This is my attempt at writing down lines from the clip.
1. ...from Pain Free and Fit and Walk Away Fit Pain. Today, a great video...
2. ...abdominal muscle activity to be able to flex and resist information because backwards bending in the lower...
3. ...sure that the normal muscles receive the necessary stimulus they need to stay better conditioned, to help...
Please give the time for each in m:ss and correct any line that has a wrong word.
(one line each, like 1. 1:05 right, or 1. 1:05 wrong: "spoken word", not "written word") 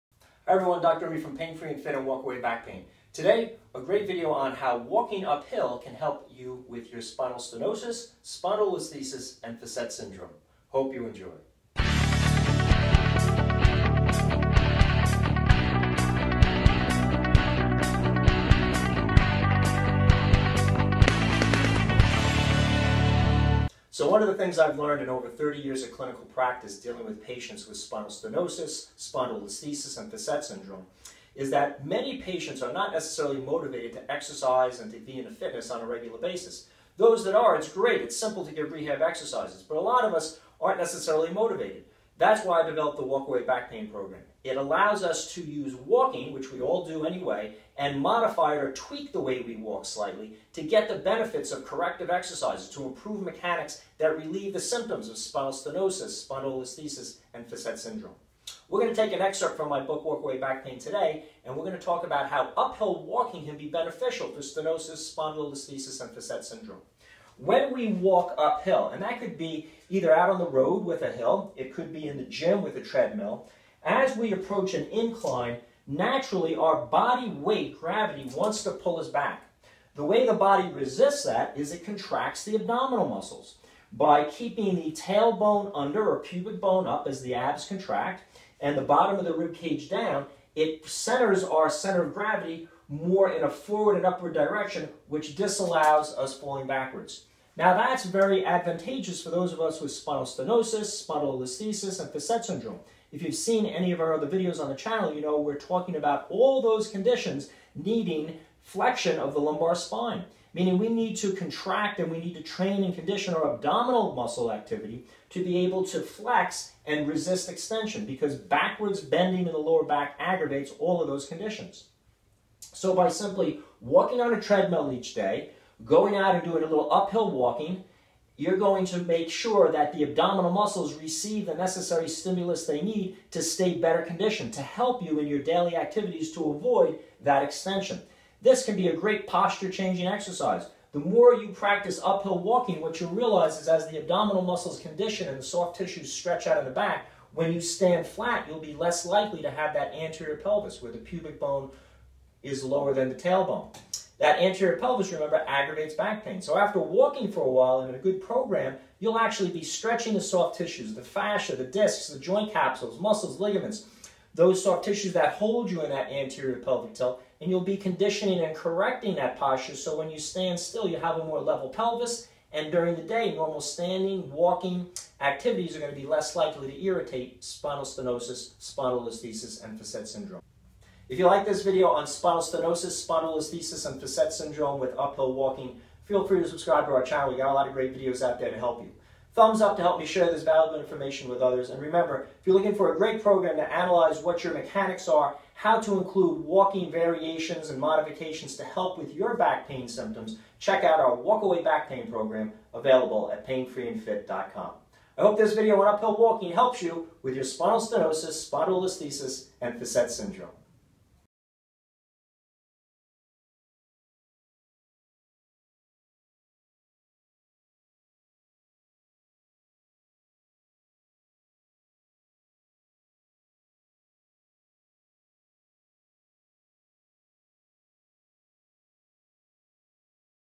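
1. 0:01 wrong: "Back", not "Fit"
2. 1:53 wrong: "extension", not "information"
3. 2:09 wrong: "abdominal", not "normal".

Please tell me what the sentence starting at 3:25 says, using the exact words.
I hope this video on uphill walking helps you with your spinal stenosis, spondylolisthesis, and facet syndrome.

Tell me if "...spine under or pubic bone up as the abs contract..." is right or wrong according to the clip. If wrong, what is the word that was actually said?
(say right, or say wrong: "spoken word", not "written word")
wrong: "tailbone", not "spine".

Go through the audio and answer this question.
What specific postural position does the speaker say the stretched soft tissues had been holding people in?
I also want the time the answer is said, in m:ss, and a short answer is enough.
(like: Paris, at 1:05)
anterior pelvic tilt, at 2:46.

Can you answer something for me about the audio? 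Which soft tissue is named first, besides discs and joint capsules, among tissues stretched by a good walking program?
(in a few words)
fascia.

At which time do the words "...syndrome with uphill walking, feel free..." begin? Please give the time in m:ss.
3:04.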